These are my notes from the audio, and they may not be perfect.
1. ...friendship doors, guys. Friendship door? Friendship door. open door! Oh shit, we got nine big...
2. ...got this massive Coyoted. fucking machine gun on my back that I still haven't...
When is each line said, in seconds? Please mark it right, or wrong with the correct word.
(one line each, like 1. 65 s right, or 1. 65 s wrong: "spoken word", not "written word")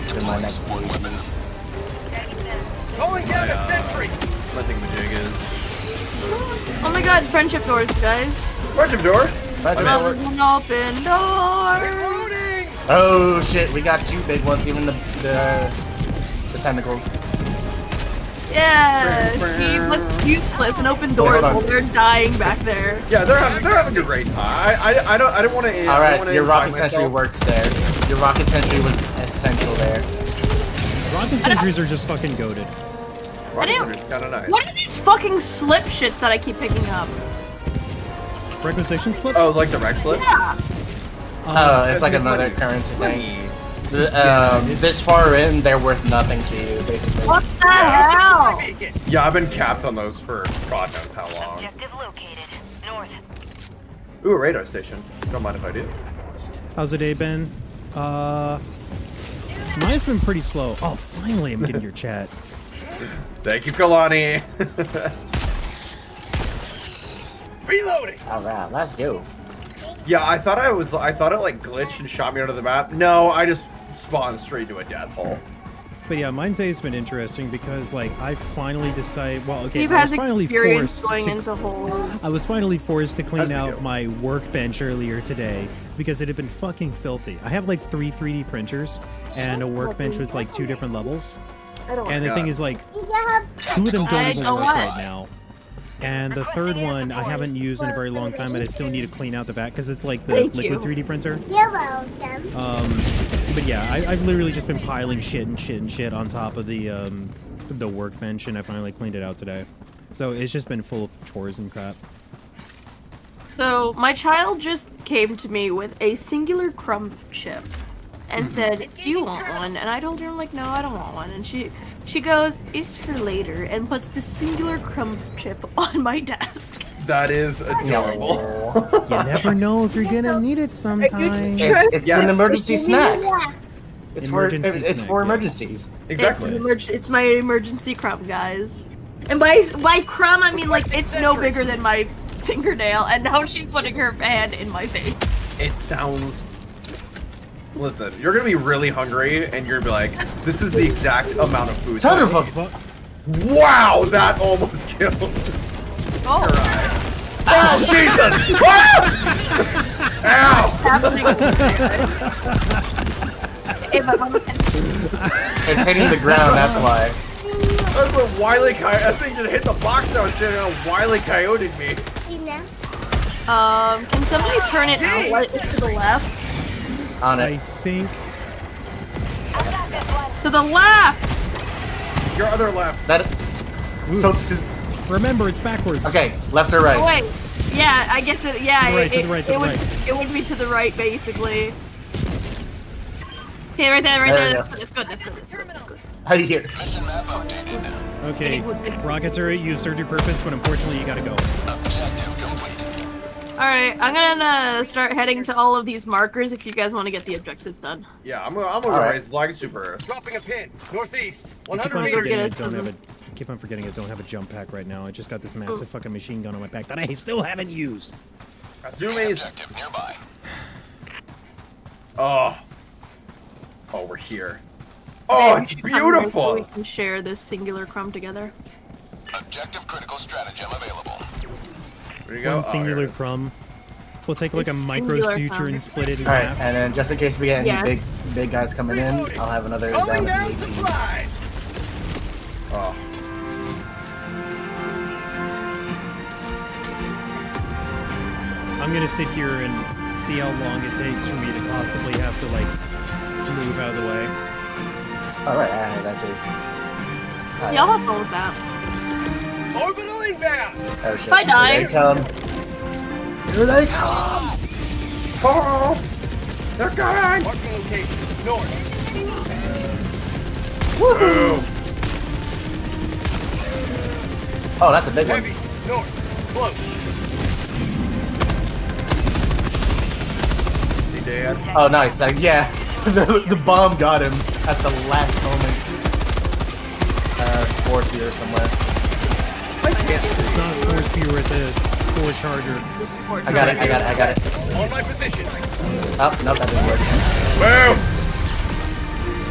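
1. 7 s wrong: "two", not "nine"
2. 215 s wrong: "Ooh", not "Coyoted".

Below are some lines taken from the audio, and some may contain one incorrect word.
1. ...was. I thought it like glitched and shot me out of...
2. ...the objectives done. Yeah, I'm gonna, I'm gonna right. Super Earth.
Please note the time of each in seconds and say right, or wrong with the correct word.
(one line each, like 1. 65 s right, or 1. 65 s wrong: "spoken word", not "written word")
1. 70 s right
2. 207 s right.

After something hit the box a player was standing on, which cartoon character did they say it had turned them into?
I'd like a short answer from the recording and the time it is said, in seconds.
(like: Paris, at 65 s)
Wiley Coyote, at 170 s.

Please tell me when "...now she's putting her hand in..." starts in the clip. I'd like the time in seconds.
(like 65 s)
143 s.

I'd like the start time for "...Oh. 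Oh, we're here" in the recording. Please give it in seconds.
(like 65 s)
222 s.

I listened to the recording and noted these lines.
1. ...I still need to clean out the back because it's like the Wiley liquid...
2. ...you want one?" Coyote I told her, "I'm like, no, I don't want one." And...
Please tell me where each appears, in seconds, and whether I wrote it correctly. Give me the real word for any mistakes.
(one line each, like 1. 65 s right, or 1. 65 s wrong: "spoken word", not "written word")
1. 98 s wrong: "Thank", not "Wiley"
2. 119 s wrong: "And", not "Coyote".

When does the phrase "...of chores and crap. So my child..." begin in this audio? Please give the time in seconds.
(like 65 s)
111 s.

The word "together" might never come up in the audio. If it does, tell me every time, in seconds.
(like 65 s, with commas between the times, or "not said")
228 s.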